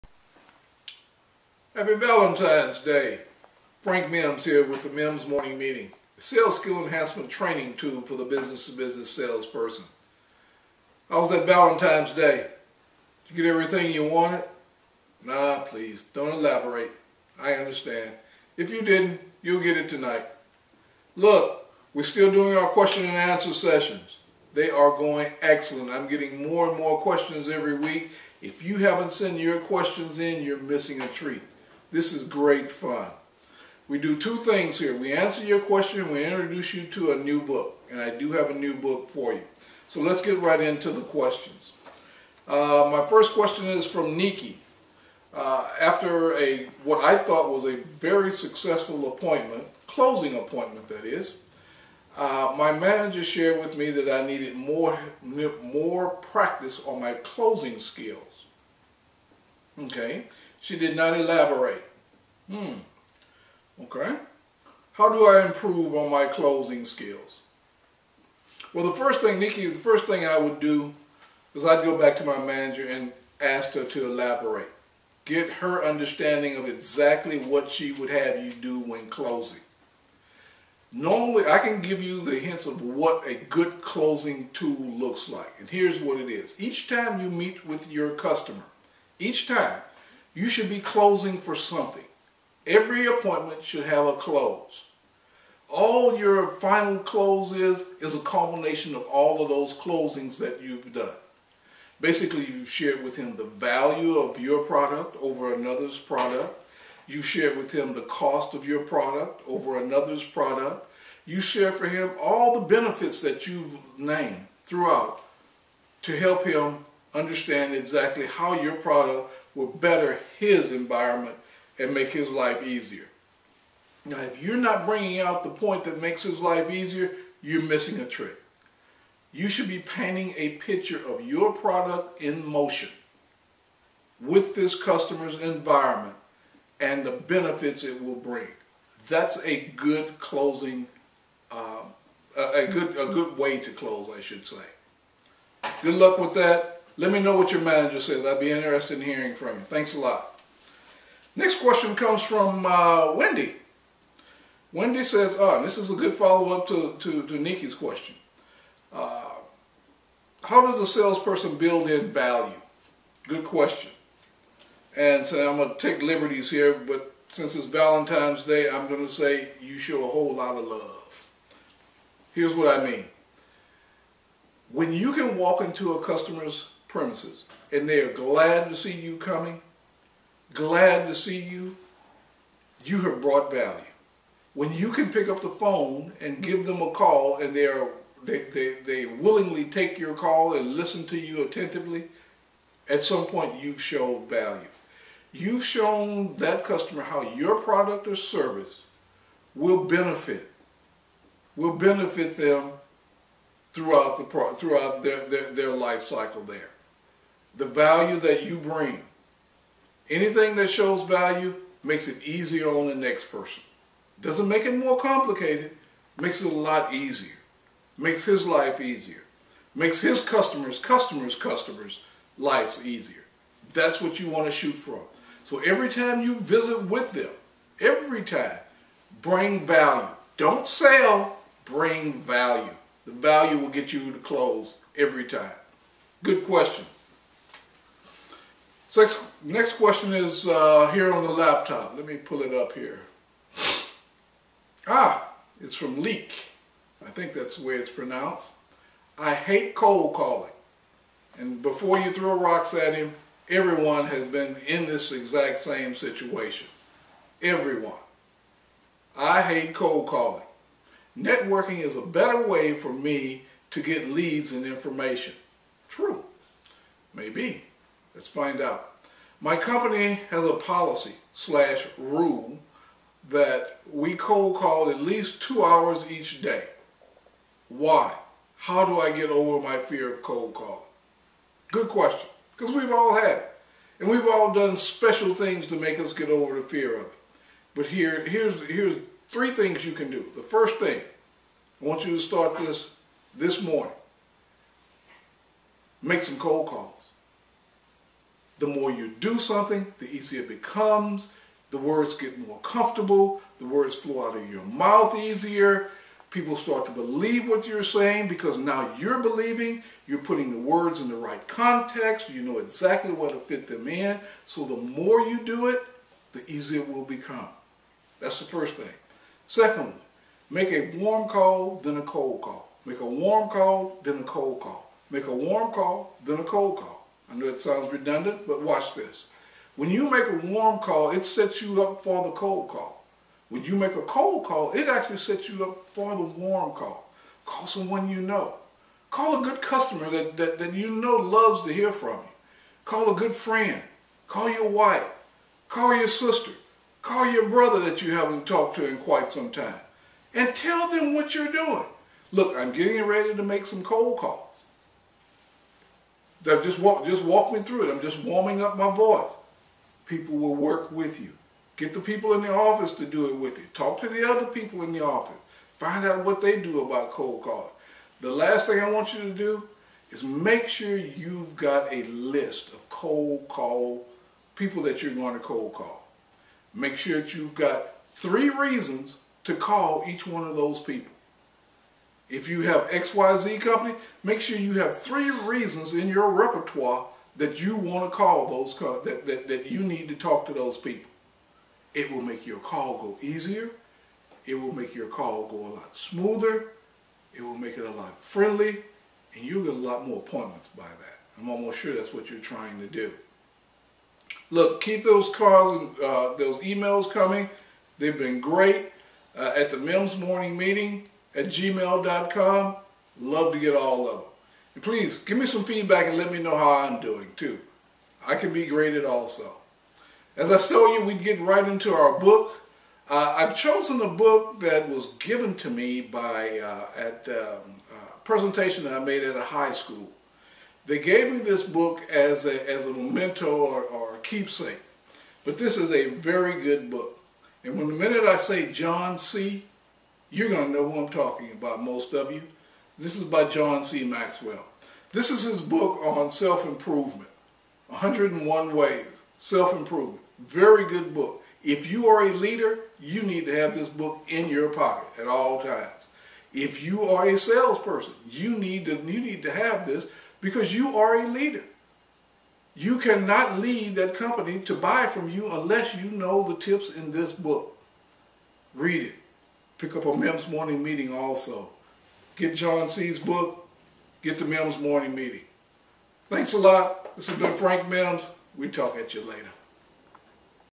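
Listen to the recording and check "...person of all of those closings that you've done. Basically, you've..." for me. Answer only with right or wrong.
wrong.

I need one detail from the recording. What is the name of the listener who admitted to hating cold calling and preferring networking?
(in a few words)
Leek.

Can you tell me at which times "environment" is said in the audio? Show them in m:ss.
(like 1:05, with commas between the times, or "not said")
2:00, 2:15.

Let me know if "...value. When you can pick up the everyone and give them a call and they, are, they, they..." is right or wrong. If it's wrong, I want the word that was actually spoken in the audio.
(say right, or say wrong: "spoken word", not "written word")
wrong: "phone", not "everyone".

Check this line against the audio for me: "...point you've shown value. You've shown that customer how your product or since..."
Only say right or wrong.
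wrong.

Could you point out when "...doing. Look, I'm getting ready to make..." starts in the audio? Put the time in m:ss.
5:51.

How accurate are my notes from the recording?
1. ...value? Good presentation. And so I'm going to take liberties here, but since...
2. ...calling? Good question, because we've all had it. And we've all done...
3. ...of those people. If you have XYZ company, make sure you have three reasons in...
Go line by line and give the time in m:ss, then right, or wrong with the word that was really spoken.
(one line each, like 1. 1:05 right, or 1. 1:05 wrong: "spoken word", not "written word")
1. 2:42 wrong: "question", not "presentation"
2. 4:40 right
3. 6:20 right.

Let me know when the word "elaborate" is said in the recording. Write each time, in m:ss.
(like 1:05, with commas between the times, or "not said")
0:16, 1:01, 1:14.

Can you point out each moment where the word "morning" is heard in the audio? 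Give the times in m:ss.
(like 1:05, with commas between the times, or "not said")
0:05, 4:53, 6:50, 7:50, 7:54.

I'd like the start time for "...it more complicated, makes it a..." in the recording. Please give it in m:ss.
3:34.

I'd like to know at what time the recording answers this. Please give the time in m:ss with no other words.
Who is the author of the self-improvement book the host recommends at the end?
7:23.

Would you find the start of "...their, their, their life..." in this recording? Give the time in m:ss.
3:25.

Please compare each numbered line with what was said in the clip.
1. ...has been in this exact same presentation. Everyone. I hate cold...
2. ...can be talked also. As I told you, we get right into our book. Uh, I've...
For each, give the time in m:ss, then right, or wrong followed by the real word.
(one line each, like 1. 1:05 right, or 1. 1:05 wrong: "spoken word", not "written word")
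1. 4:14 wrong: "situation", not "presentation"
2. 6:58 wrong: "graded", not "talked".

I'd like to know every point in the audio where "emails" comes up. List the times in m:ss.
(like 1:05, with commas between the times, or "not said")
6:46.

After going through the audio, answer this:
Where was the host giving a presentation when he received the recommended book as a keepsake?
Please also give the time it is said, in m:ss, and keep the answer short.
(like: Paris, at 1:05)
a high school, at 7:09.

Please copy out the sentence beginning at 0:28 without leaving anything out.
If you haven't sent your questions in, you're missing a treat.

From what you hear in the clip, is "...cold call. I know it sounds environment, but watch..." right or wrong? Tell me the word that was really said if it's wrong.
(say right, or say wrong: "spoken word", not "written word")
wrong: "redundant", not "environment".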